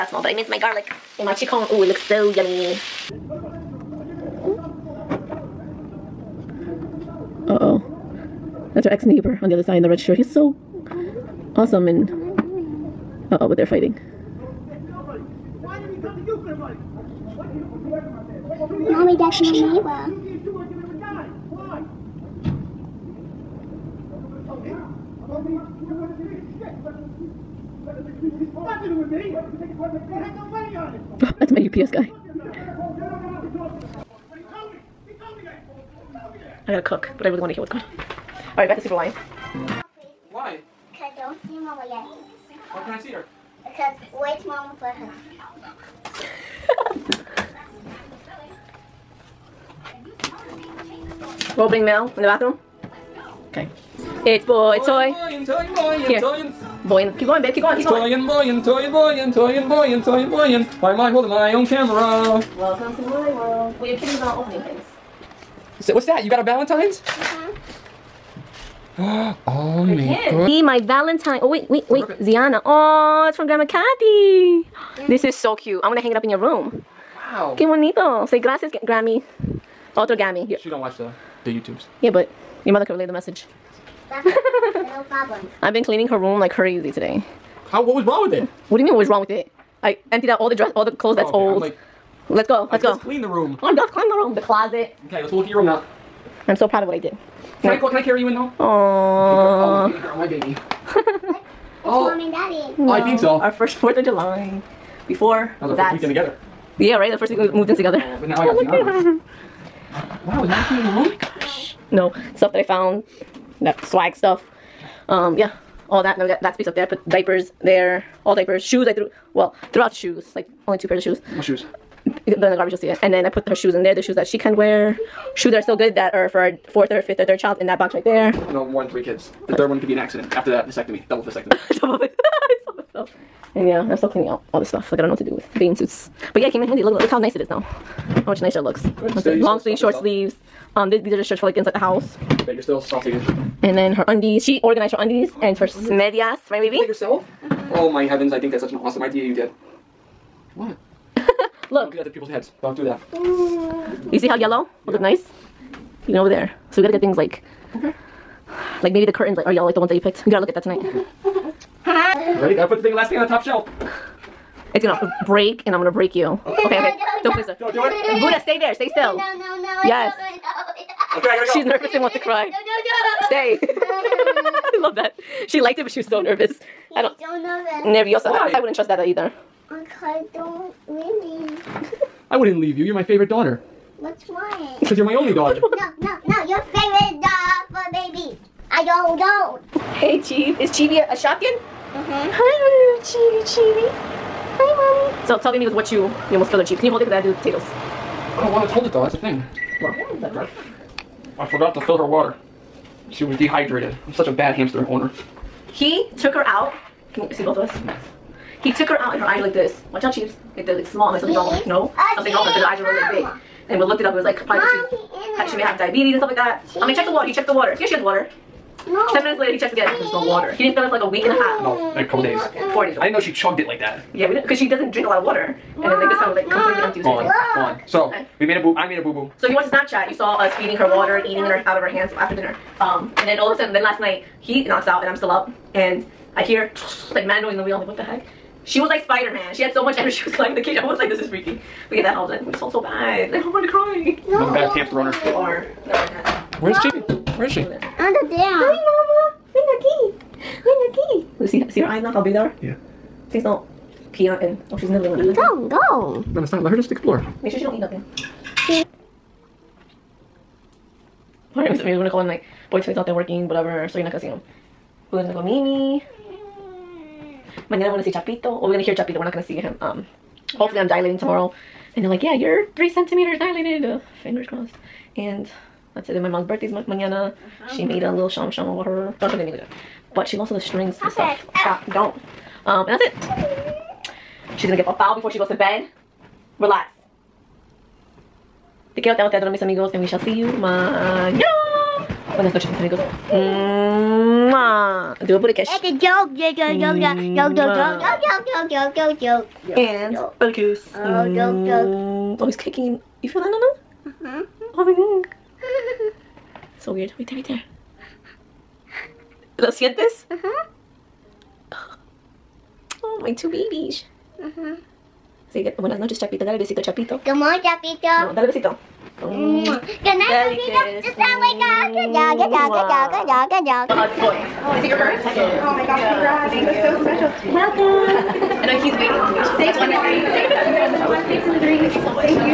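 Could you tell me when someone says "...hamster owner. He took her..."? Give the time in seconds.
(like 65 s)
204 s.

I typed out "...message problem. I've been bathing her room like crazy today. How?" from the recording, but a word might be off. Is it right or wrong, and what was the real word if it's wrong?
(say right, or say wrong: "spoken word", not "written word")
wrong: "cleaning", not "bathing".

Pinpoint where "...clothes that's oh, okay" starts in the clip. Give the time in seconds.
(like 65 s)
90 s.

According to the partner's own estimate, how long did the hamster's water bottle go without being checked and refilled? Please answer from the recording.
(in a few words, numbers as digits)
4 days.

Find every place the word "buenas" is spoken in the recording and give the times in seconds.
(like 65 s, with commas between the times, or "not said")
292 s, 315 s.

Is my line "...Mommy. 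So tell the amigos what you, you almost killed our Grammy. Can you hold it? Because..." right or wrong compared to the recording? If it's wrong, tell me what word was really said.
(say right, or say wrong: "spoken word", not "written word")
wrong: "Chief", not "Grammy".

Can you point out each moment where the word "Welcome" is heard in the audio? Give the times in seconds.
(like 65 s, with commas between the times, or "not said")
62 s, 327 s.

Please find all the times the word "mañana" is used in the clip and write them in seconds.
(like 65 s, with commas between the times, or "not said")
267 s, 276 s, 290 s.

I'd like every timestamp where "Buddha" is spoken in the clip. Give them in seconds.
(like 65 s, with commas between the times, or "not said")
168 s, 295 s, 300 s.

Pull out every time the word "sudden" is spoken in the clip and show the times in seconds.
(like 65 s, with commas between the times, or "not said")
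233 s.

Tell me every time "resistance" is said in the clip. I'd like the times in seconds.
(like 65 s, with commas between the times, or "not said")
not said.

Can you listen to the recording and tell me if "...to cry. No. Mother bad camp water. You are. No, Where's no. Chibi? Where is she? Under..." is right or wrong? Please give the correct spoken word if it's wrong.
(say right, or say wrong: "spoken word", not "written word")
wrong: "owner", not "water".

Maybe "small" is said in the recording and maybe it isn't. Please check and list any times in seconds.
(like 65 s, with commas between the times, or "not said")
0 s, 210 s.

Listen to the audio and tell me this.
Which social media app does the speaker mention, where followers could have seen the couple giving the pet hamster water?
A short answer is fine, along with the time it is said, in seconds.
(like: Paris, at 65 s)
Snapchat, at 229 s.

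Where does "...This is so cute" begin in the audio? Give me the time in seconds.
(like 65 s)
75 s.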